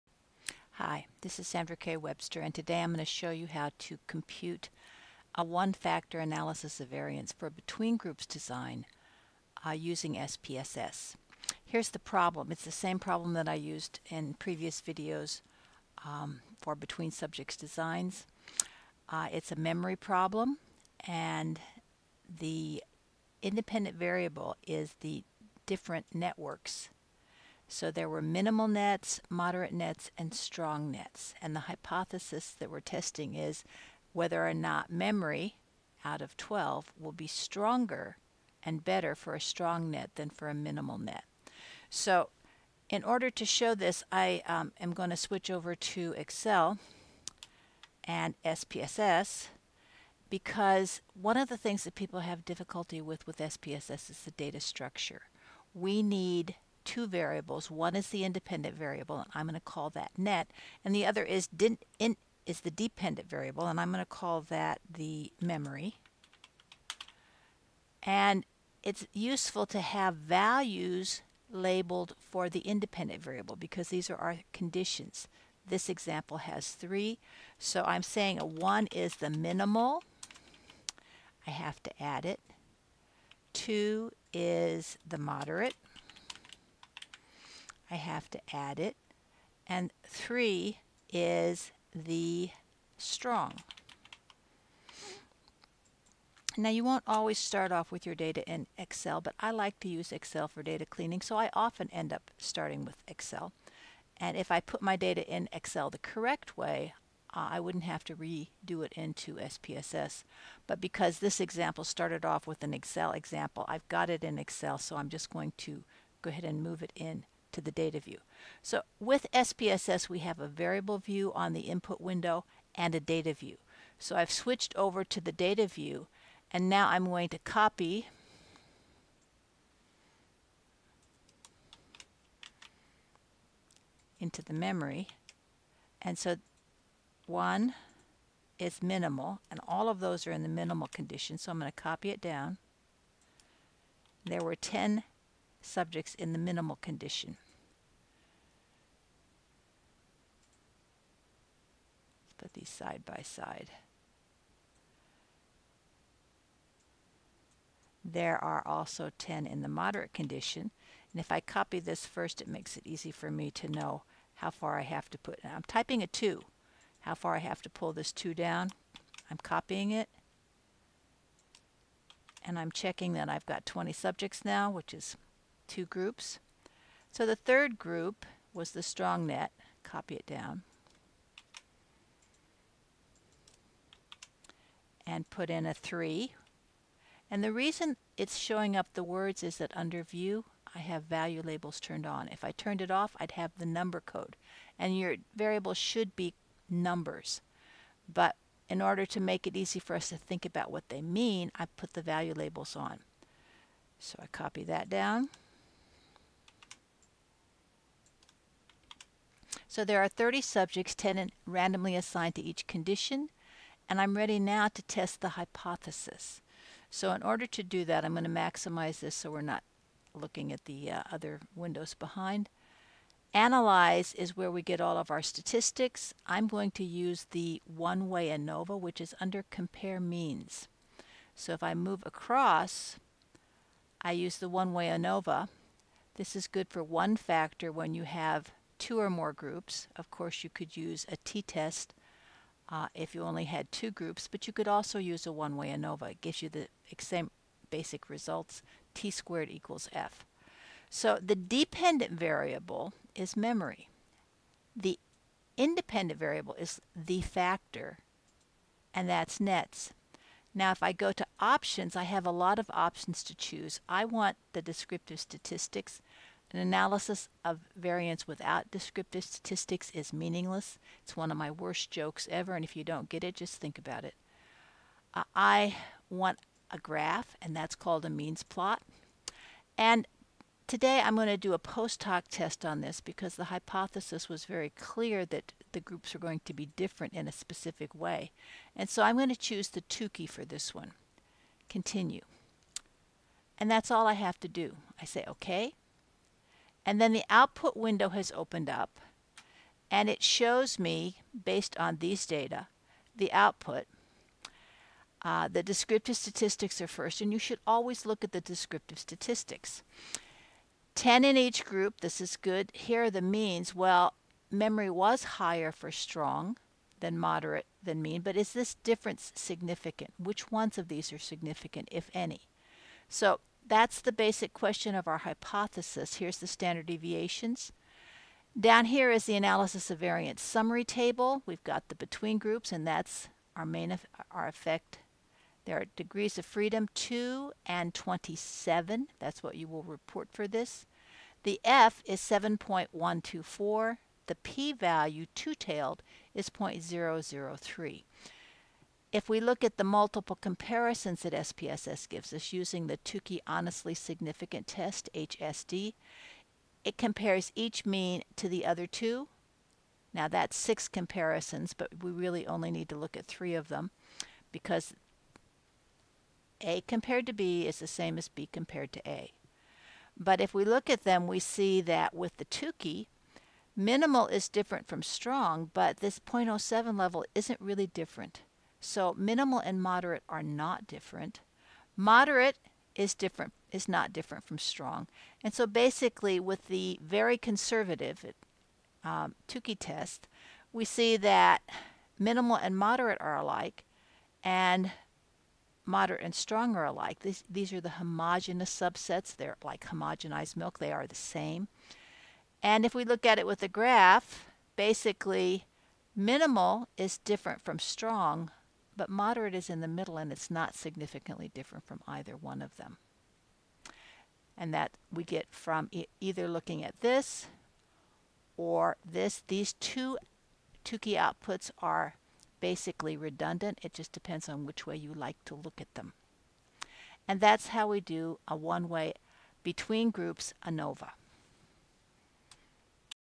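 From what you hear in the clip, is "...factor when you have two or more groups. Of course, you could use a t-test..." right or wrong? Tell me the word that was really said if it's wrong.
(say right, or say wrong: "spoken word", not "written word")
right.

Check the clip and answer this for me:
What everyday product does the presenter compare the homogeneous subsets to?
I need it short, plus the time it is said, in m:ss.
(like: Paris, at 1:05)
homogenized milk, at 6:39.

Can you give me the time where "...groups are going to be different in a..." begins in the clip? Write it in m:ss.
4:45.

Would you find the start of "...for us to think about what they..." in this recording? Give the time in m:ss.
3:19.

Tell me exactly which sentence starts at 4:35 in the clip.
Uh, I want a graph, and that's called a means plot.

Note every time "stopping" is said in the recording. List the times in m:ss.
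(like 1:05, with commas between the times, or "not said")
not said.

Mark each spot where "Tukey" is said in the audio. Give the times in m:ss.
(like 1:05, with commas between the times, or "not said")
4:49, 5:52, 6:12, 6:29, 7:00.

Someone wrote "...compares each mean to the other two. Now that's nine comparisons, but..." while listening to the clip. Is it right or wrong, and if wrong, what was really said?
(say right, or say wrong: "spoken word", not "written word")
wrong: "six", not "nine".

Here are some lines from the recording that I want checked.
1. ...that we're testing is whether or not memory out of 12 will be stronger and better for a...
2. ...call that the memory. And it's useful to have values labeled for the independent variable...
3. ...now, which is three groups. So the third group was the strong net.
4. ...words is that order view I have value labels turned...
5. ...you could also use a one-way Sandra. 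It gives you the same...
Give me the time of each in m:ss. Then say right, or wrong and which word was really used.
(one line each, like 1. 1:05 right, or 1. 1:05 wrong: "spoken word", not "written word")
1. 0:32 right
2. 1:04 right
3. 2:54 wrong: "two", not "three"
4. 3:09 wrong: "under", not "order"
5. 4:04 wrong: "ANOVA", not "Sandra".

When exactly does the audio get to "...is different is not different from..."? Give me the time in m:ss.
6:22.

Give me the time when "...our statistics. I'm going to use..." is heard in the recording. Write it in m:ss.
3:45.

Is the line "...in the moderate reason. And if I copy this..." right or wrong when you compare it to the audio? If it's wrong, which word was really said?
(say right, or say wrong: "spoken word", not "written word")
wrong: "condition", not "reason".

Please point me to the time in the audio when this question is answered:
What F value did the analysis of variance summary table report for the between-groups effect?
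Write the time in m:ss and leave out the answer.
5:41.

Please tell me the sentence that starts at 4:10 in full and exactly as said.
So the dependent variable is memory.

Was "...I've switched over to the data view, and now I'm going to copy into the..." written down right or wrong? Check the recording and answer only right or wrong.
right.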